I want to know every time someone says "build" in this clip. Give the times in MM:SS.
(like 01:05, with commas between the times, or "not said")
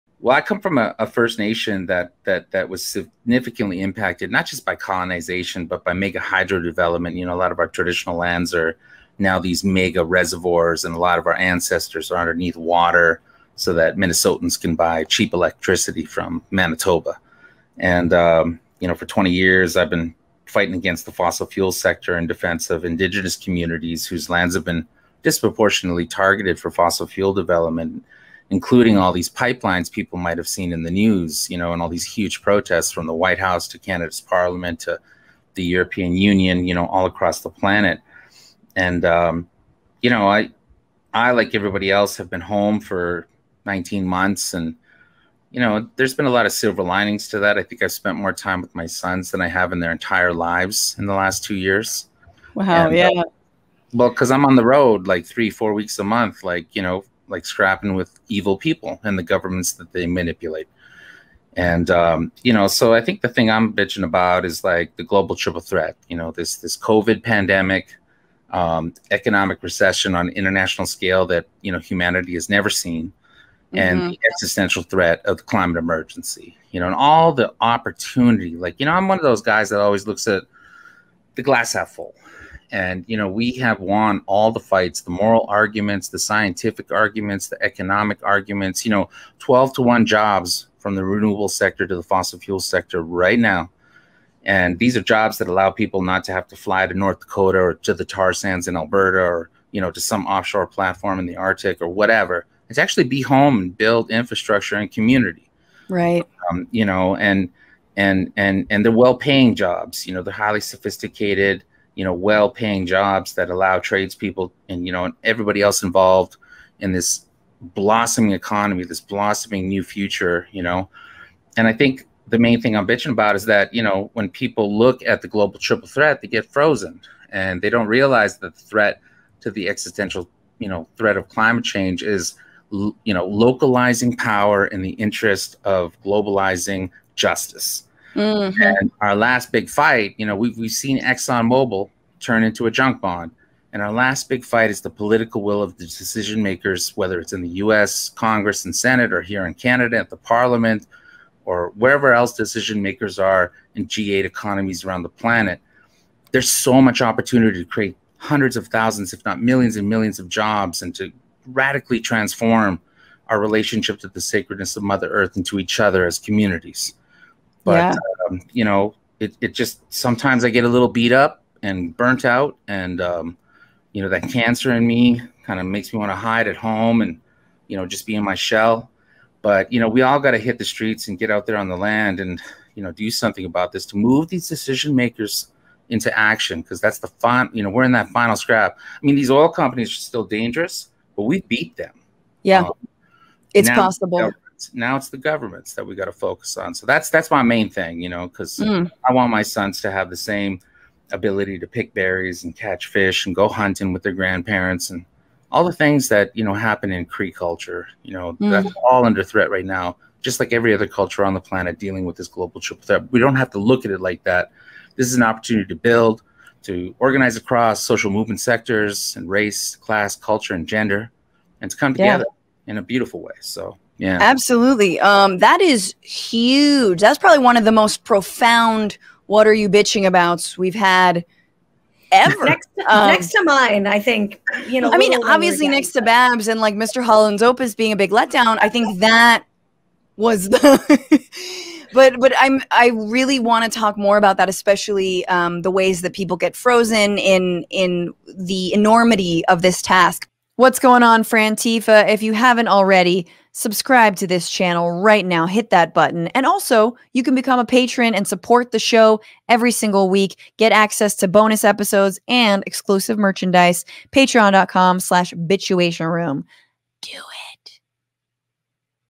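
01:43, 03:35.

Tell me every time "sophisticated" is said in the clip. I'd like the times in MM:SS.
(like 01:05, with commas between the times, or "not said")
01:50.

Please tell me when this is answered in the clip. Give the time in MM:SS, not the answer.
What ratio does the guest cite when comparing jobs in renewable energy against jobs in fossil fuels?
01:29.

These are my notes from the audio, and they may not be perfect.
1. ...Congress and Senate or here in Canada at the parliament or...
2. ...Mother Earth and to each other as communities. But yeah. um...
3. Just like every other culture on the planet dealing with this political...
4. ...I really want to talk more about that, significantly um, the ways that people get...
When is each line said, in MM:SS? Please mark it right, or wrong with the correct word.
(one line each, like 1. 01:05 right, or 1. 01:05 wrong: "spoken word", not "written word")
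1. 02:28 right
2. 02:44 right
3. 03:30 wrong: "global", not "political"
4. 04:02 wrong: "especially", not "significantly".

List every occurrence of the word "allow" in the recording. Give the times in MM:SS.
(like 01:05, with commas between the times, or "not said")
01:35, 01:53.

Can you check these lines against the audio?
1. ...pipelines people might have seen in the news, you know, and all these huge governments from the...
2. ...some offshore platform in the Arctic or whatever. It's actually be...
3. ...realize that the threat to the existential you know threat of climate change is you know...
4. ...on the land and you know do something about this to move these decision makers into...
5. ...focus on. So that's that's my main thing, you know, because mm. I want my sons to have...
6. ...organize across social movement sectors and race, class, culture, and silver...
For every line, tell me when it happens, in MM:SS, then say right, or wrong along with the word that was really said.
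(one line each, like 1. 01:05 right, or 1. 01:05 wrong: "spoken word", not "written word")
1. 00:29 wrong: "protests", not "governments"
2. 01:39 right
3. 02:07 right
4. 03:01 right
5. 03:16 right
6. 03:36 wrong: "gender", not "silver".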